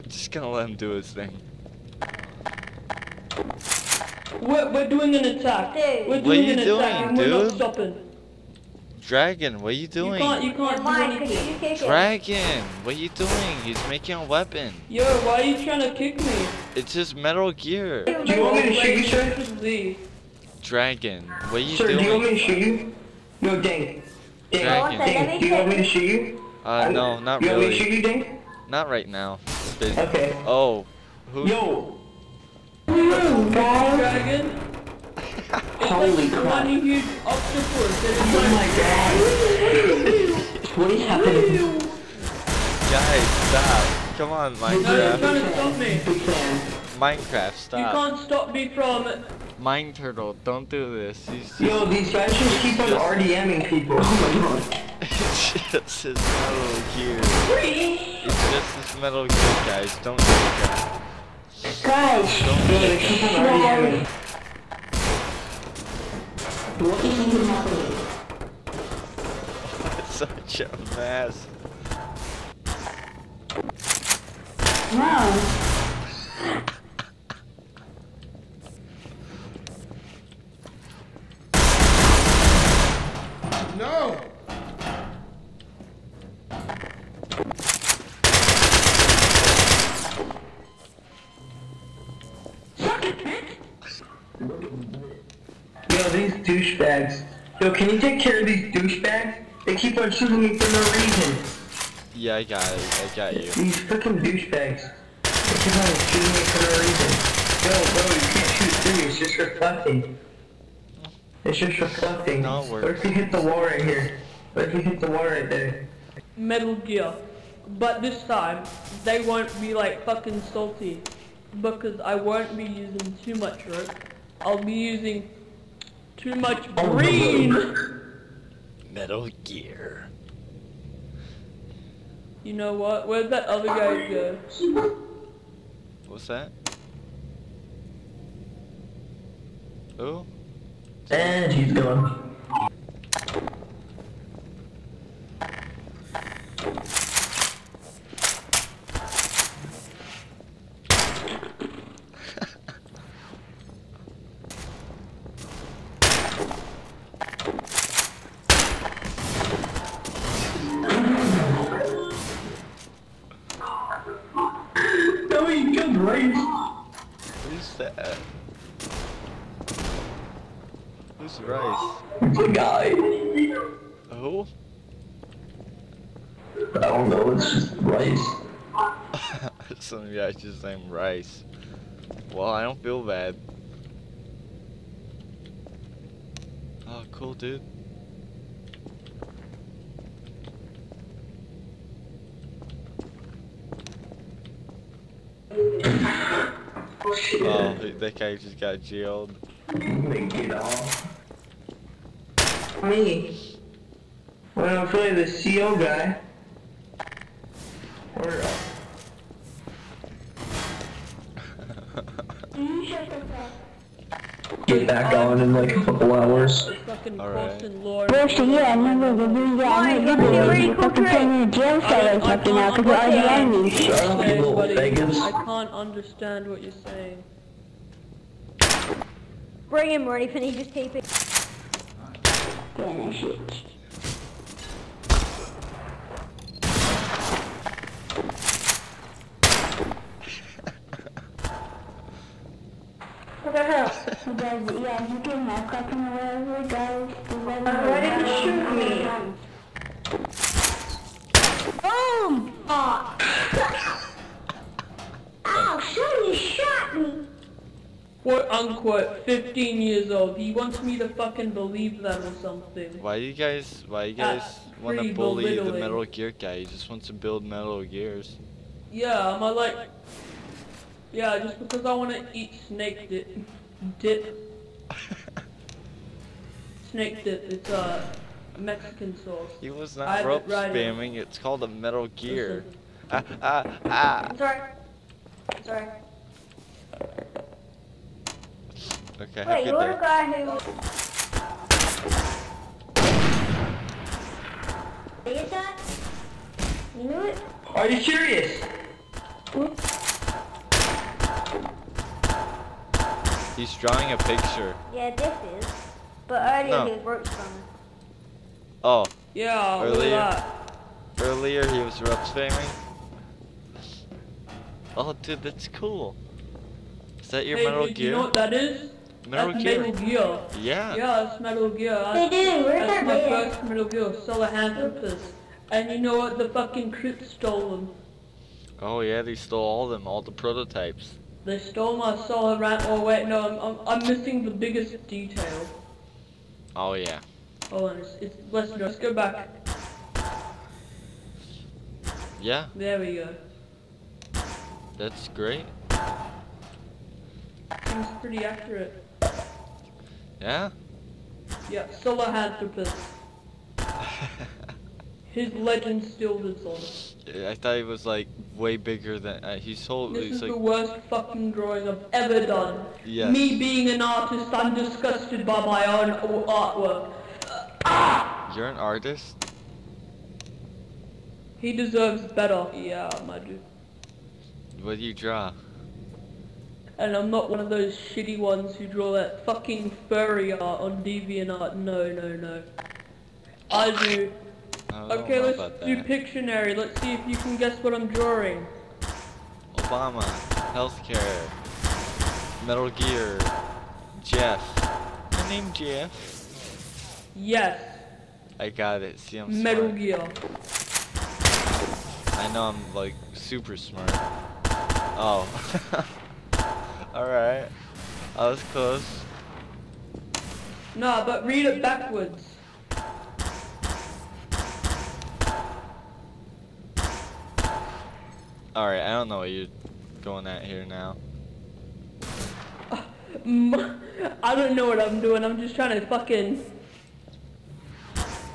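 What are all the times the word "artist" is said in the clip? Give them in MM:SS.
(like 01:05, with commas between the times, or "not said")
06:04, 06:08.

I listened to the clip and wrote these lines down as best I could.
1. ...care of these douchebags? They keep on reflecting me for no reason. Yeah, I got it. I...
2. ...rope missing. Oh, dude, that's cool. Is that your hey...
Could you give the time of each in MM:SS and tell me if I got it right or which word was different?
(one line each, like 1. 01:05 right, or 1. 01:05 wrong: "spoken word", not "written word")
1. 01:38 wrong: "shooting", not "reflecting"
2. 05:12 wrong: "spamming", not "missing".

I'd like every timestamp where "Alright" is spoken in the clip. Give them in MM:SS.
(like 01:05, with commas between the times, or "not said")
06:47, 06:58.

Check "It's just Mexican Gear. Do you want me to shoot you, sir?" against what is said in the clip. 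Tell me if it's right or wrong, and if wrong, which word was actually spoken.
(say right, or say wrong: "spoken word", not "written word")
wrong: "Metal", not "Mexican".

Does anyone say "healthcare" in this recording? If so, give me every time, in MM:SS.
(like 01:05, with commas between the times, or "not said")
06:30.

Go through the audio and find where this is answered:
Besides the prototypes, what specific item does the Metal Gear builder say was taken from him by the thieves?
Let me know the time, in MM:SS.
05:32.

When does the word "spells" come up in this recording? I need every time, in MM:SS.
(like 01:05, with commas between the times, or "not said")
not said.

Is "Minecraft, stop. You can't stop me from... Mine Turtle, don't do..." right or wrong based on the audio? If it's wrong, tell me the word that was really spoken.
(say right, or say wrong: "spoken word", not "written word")
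right.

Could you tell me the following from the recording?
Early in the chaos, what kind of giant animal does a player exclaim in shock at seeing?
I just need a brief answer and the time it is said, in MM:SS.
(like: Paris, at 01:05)
Octopus, at 00:37.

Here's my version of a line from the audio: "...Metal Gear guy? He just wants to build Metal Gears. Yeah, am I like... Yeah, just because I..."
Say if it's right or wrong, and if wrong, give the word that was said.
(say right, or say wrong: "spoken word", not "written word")
right.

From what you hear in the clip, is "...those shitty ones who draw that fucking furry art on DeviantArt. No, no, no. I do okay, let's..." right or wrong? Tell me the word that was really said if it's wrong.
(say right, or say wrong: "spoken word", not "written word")
right.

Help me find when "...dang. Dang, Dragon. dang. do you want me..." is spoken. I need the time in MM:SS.
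00:23.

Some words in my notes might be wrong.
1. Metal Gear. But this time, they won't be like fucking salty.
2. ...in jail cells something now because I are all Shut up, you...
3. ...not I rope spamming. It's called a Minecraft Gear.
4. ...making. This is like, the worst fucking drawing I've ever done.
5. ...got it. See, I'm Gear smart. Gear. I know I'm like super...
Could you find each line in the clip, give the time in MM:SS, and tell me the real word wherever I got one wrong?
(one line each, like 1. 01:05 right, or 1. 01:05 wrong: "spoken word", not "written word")
1. 01:56 right
2. 03:41 right
3. 04:39 wrong: "Metal", not "Minecraft"
4. 05:59 wrong: "holding", not "making"
5. 06:38 wrong: "Metal", not "Gear".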